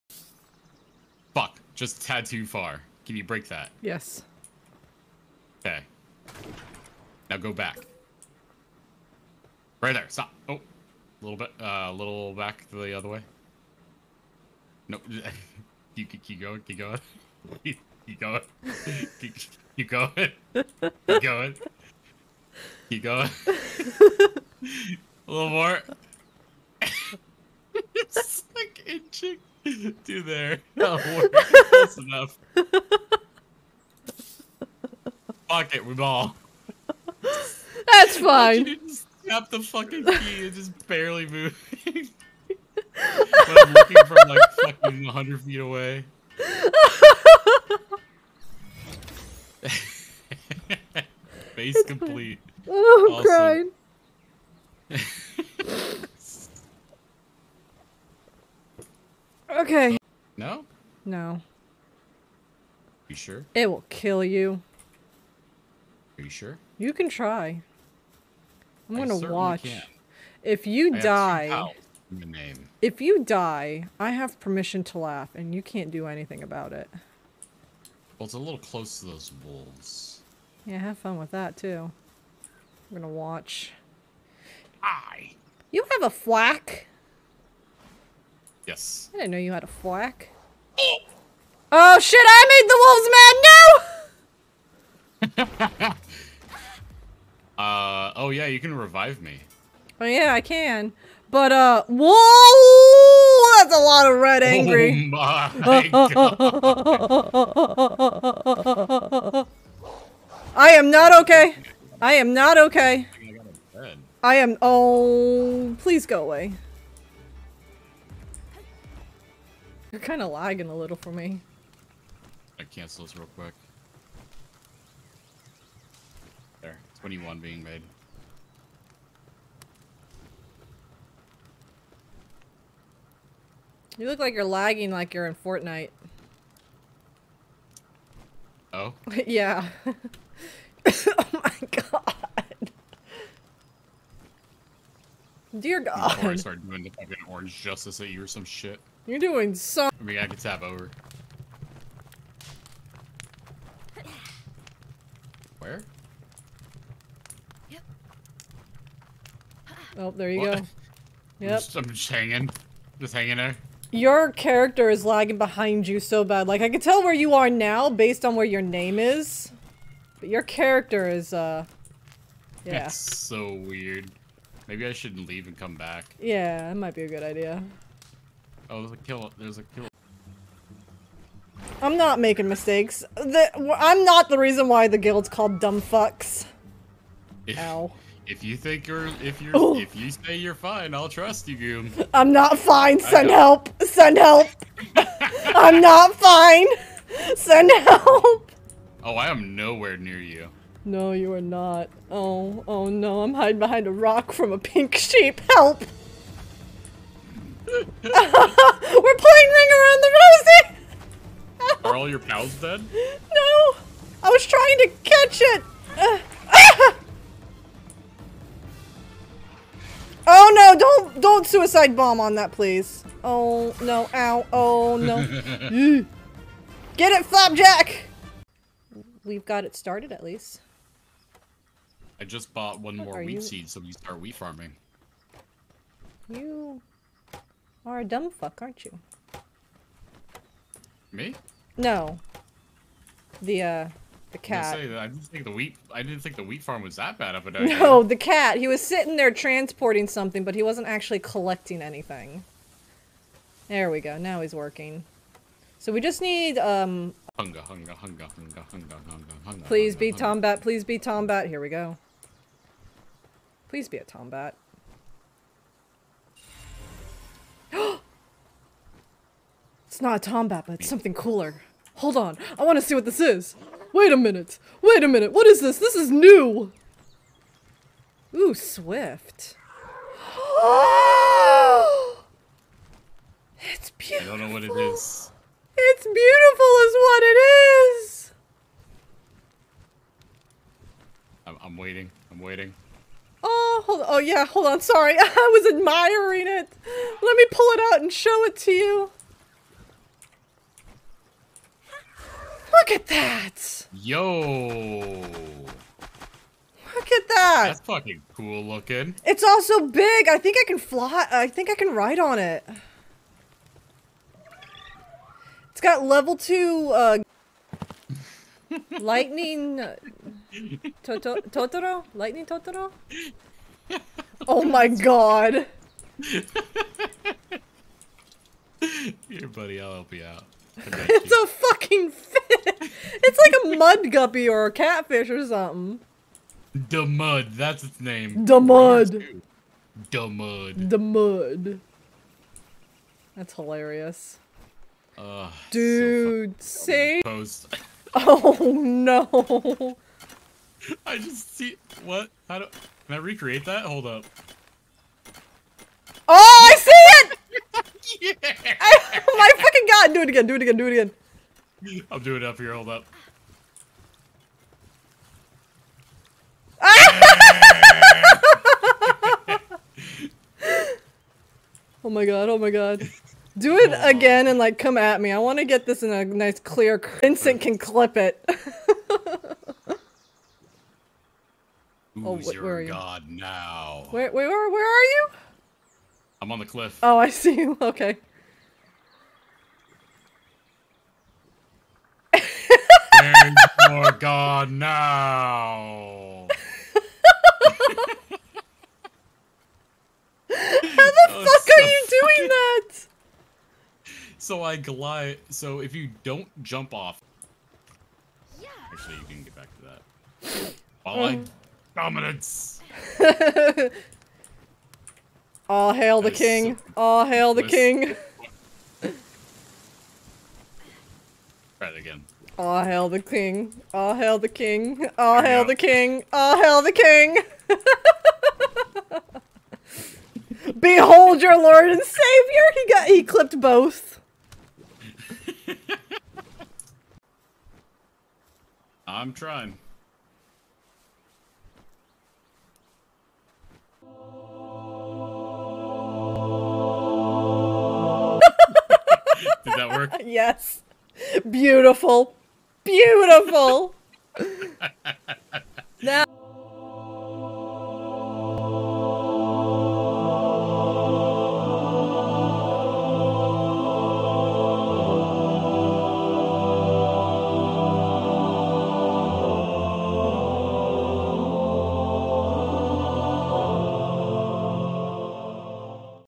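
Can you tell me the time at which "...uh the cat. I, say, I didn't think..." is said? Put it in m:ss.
4:03.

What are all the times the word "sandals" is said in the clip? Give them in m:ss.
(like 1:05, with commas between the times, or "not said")
not said.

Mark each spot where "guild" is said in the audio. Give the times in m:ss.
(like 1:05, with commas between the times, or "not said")
3:04.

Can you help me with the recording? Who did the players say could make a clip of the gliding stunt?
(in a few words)
Vincent.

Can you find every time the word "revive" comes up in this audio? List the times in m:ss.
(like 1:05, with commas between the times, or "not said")
1:38.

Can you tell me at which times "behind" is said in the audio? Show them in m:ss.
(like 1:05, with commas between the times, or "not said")
2:45, 3:23.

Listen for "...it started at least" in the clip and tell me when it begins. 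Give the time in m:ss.
3:49.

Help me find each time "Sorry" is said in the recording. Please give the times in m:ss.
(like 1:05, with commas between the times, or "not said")
4:54.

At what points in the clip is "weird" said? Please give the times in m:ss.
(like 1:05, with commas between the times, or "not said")
2:53.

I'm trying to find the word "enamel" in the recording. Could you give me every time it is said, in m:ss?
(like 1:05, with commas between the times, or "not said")
not said.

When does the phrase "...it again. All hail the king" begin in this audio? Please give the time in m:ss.
7:01.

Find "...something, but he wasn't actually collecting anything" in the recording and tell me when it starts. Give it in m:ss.
4:10.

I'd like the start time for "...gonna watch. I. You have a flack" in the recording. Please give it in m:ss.
1:22.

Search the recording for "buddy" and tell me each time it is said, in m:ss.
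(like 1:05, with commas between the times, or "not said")
5:29.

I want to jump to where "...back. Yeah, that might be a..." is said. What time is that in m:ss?
2:55.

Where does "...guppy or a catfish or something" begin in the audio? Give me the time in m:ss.
5:34.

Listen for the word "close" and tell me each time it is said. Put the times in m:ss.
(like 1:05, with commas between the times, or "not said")
0:31, 1:18.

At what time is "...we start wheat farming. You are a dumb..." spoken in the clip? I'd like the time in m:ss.
3:53.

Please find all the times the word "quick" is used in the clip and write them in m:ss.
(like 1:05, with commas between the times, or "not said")
2:03.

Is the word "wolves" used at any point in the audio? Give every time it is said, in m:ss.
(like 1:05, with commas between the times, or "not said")
1:19, 1:35.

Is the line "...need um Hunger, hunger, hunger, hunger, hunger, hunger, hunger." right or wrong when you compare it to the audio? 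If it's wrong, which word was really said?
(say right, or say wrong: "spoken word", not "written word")
right.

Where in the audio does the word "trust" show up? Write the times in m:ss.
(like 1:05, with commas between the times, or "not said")
3:11.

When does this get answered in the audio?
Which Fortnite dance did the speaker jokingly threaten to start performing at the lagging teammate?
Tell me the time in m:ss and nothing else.
2:27.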